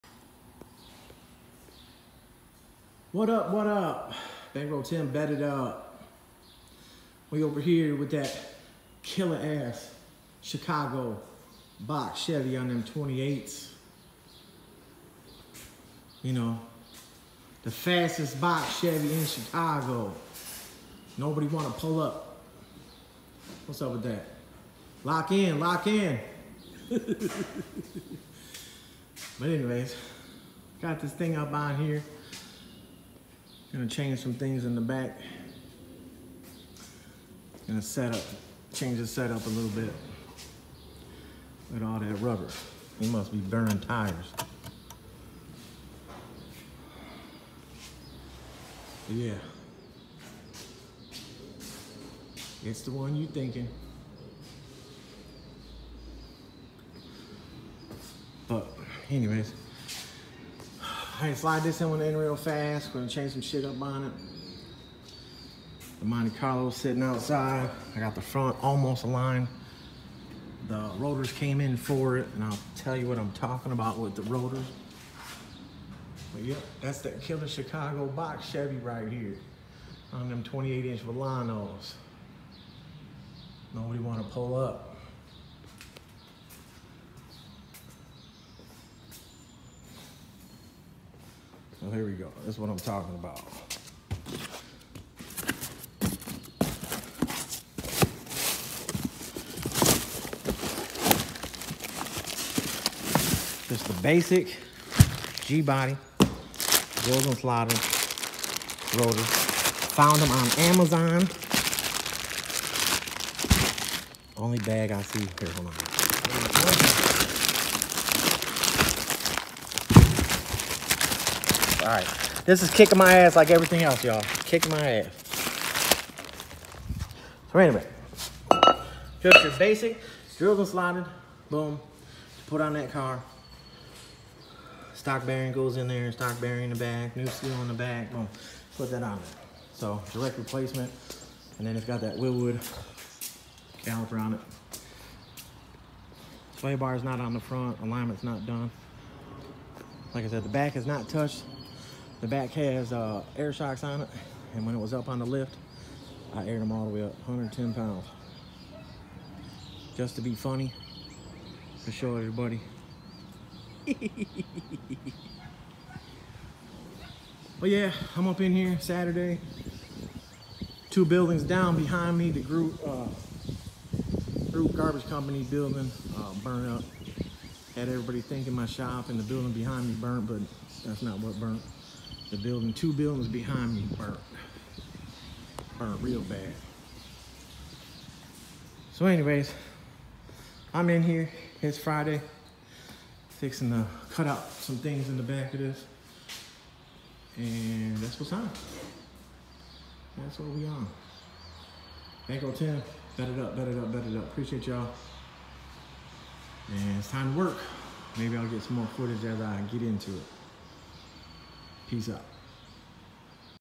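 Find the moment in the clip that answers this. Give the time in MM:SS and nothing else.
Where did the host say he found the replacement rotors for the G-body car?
01:50.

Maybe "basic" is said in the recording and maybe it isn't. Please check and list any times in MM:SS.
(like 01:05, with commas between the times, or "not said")
01:44, 02:09.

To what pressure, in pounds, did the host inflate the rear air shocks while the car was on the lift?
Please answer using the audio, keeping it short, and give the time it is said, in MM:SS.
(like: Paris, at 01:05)
110 pounds, at 02:37.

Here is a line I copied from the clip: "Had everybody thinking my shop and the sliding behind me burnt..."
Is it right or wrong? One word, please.
wrong.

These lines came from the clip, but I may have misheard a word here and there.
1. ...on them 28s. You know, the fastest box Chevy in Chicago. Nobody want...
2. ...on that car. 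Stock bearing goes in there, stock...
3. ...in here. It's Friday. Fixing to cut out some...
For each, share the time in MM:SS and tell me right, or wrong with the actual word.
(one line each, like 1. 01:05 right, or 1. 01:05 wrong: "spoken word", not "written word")
1. 00:12 right
2. 02:12 right
3. 03:10 right.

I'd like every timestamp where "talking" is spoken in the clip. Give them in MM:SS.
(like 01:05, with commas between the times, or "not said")
01:13, 01:32.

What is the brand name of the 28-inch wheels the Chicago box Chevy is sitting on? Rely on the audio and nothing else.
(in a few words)
Vellanos.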